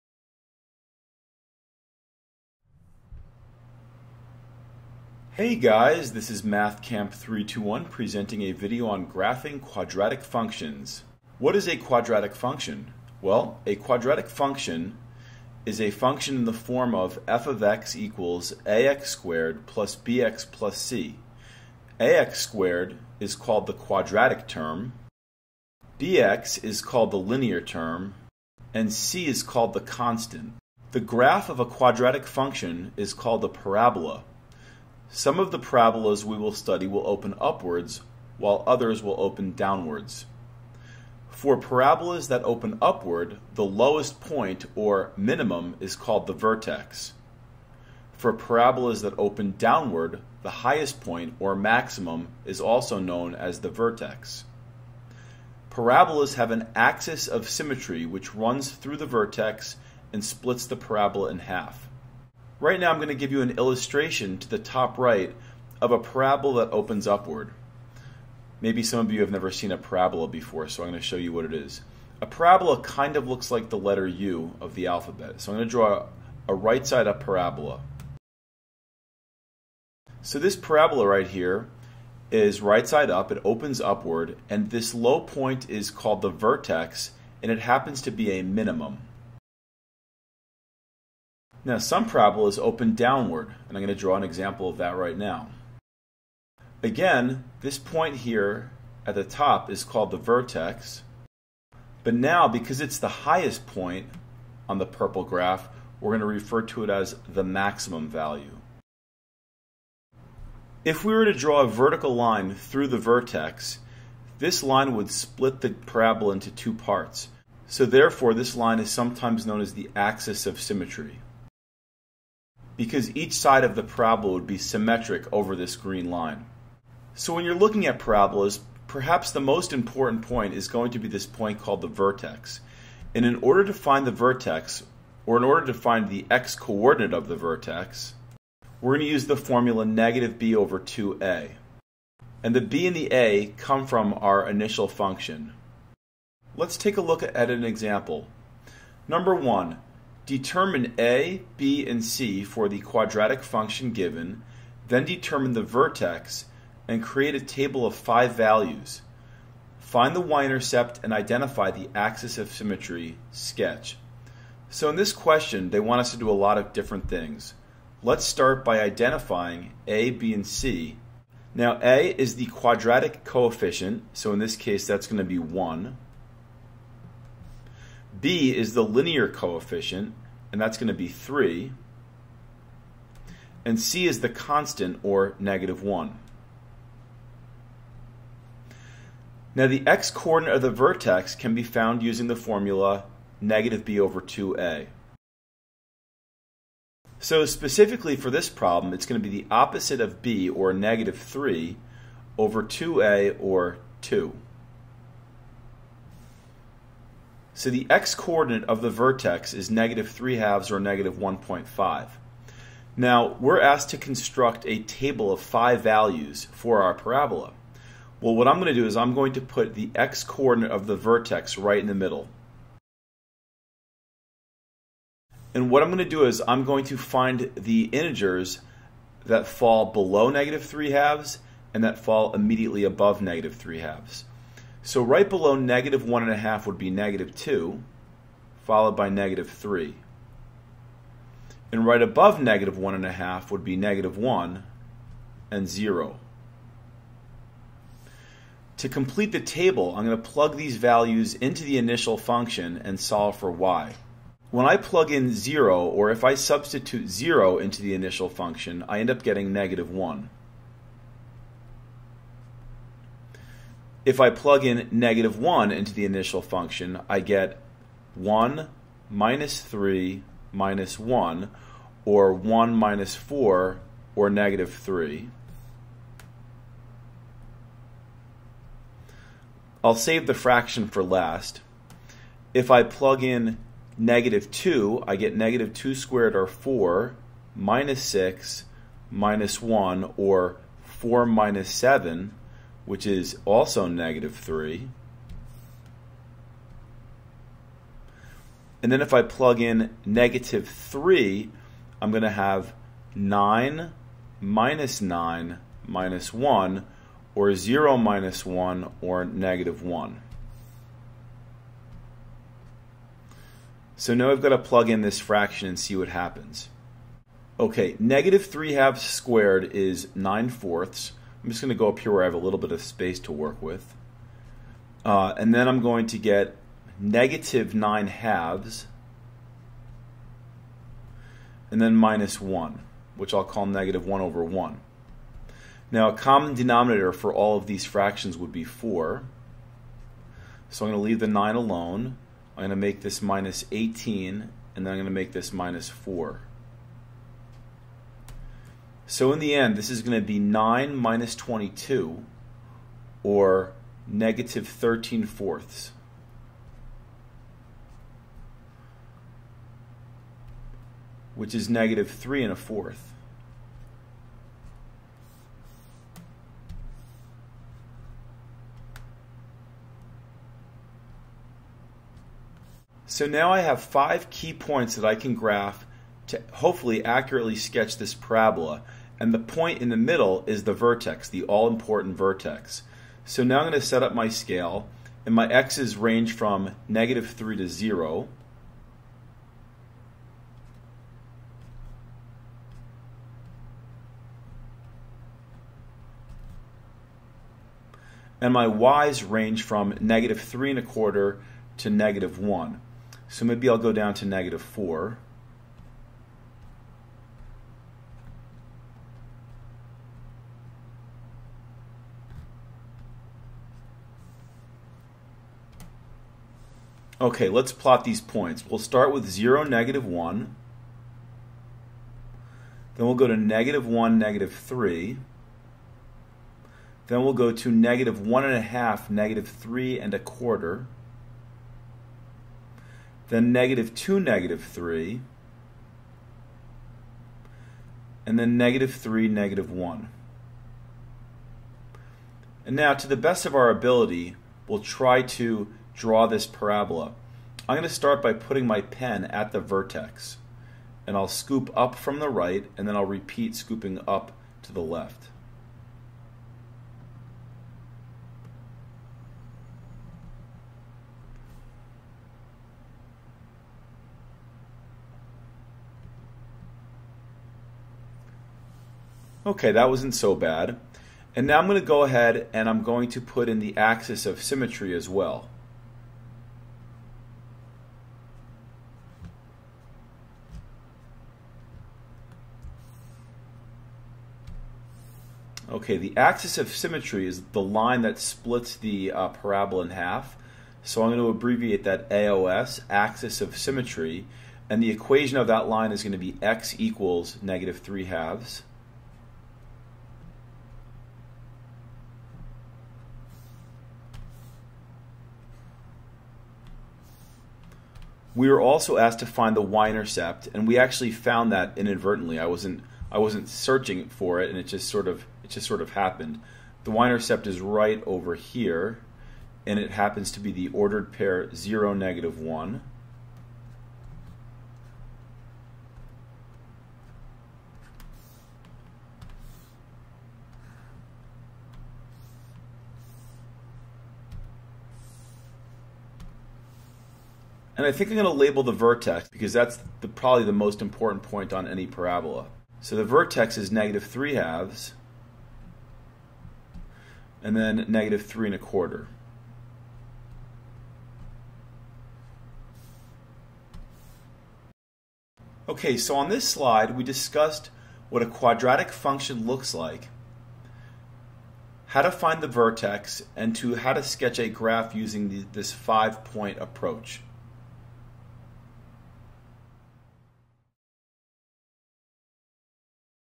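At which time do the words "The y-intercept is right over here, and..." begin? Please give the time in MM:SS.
08:36.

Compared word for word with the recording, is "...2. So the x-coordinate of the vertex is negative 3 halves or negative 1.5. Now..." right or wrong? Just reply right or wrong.
right.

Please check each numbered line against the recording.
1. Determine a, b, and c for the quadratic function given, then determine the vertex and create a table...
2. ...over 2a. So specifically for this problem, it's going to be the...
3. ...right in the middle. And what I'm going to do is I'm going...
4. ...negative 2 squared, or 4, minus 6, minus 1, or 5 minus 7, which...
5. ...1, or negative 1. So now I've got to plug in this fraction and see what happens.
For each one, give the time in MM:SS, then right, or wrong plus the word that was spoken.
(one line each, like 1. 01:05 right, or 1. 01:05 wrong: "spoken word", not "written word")
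1. 02:30 right
2. 03:13 right
3. 03:41 right
4. 04:45 wrong: "4", not "5"
5. 05:08 right.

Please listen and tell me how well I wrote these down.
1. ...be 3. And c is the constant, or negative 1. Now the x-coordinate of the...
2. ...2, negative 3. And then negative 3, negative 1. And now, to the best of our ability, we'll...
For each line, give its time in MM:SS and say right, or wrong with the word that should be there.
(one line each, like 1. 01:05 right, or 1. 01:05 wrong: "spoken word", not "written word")
1. 03:00 right
2. 07:13 right.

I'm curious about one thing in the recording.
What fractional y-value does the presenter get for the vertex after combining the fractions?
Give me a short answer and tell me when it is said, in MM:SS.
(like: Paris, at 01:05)
-13/4, at 05:54.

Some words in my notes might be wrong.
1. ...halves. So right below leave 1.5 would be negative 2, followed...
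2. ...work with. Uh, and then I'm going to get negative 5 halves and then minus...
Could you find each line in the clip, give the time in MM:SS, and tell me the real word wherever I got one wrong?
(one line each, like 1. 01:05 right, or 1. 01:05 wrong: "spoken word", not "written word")
1. 03:53 wrong: "negative", not "leave"
2. 05:23 wrong: "9", not "5".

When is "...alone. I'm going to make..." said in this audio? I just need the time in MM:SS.
05:41.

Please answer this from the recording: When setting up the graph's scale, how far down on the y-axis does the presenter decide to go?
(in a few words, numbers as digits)
-4.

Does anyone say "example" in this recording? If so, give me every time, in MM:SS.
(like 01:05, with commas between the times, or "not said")
01:34, 02:27.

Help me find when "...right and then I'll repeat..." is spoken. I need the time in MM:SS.
07:32.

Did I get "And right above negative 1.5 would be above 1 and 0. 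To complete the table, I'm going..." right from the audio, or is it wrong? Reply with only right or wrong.
wrong.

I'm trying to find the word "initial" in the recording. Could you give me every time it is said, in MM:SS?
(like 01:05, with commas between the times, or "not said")
02:24, 04:11, 04:17, 04:26.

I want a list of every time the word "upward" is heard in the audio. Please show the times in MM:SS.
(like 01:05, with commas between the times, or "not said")
00:37, 00:42, 01:07, 01:23.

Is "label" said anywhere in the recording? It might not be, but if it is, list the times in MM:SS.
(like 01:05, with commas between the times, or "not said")
08:58.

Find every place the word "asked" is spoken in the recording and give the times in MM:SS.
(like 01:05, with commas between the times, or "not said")
03:33, 08:28.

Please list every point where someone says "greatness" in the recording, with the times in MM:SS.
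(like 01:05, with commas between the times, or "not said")
not said.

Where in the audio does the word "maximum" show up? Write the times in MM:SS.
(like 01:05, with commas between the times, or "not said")
00:51, 01:47.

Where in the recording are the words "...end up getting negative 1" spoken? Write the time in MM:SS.
04:18.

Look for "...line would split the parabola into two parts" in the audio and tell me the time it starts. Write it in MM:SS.
01:54.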